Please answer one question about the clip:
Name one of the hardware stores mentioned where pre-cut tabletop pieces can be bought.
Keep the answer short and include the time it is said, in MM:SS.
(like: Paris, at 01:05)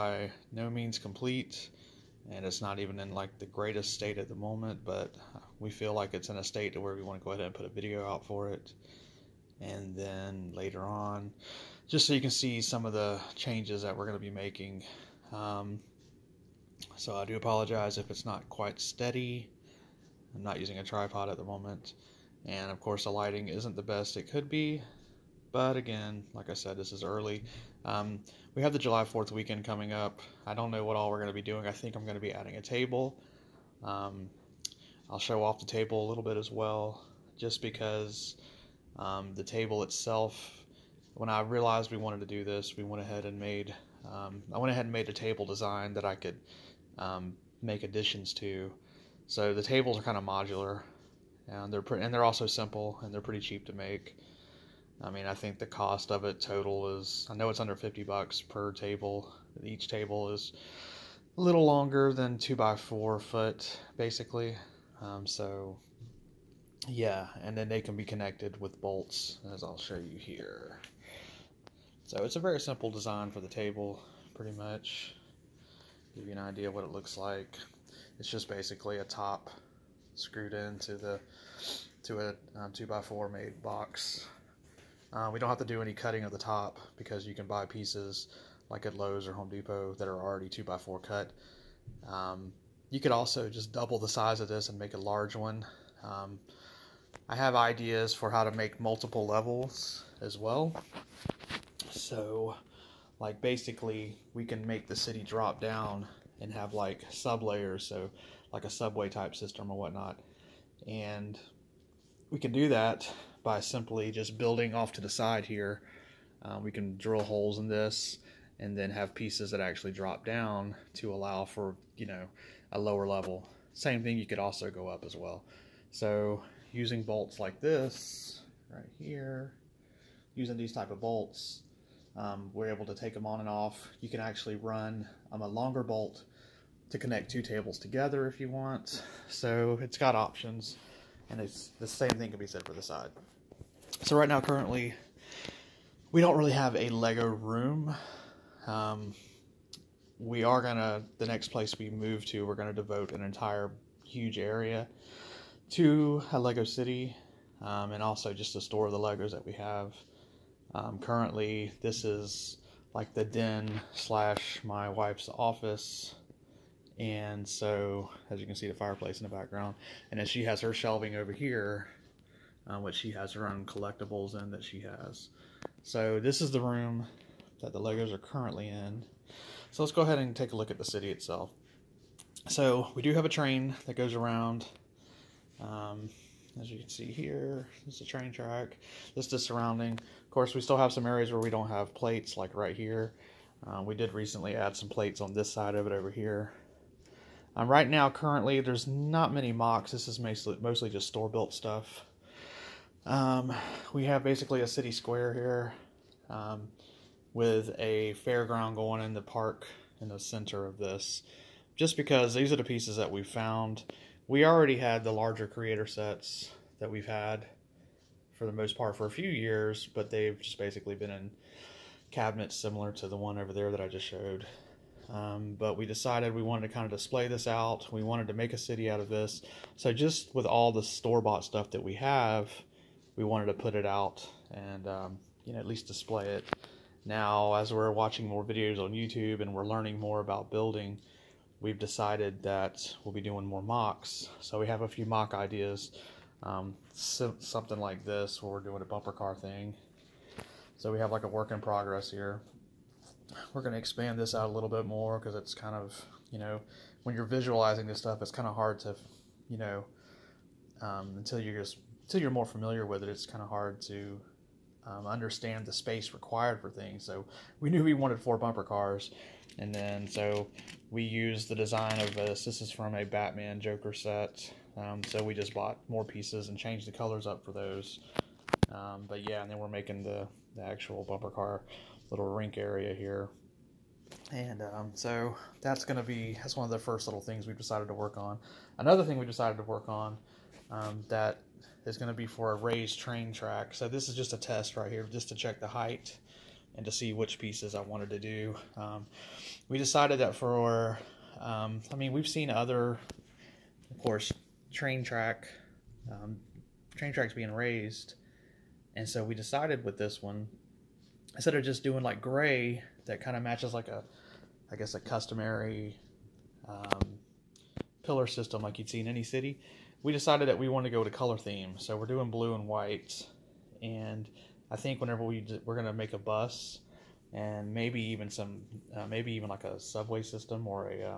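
Lowe's, at 01:28.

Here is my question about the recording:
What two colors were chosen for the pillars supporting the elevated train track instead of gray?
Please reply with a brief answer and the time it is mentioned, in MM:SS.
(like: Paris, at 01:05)
blue and white, at 05:22.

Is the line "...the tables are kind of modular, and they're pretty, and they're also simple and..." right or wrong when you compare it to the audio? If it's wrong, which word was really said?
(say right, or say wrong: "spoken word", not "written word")
right.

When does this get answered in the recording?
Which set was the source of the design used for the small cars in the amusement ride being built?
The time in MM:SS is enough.
04:33.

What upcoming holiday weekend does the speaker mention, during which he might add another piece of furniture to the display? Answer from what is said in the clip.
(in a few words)
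July 4th.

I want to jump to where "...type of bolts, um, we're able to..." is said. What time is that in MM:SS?
02:10.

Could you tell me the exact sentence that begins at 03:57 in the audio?
Now, as we're watching more videos on YouTube and we're learning more about building, we've decided that we'll be doing more mocks.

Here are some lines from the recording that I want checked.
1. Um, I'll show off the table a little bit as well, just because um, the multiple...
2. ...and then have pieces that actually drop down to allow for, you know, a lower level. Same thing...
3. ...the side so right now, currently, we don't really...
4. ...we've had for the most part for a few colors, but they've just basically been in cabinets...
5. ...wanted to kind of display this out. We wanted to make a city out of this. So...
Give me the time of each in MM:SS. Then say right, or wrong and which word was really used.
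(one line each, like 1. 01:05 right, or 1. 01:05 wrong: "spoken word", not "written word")
1. 00:33 wrong: "table", not "multiple"
2. 01:58 right
3. 02:22 right
4. 03:36 wrong: "years", not "colors"
5. 03:46 right.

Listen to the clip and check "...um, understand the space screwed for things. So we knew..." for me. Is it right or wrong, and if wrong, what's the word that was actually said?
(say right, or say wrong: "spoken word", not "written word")
wrong: "required", not "screwed".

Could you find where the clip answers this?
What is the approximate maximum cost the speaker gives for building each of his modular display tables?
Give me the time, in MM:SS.
00:57.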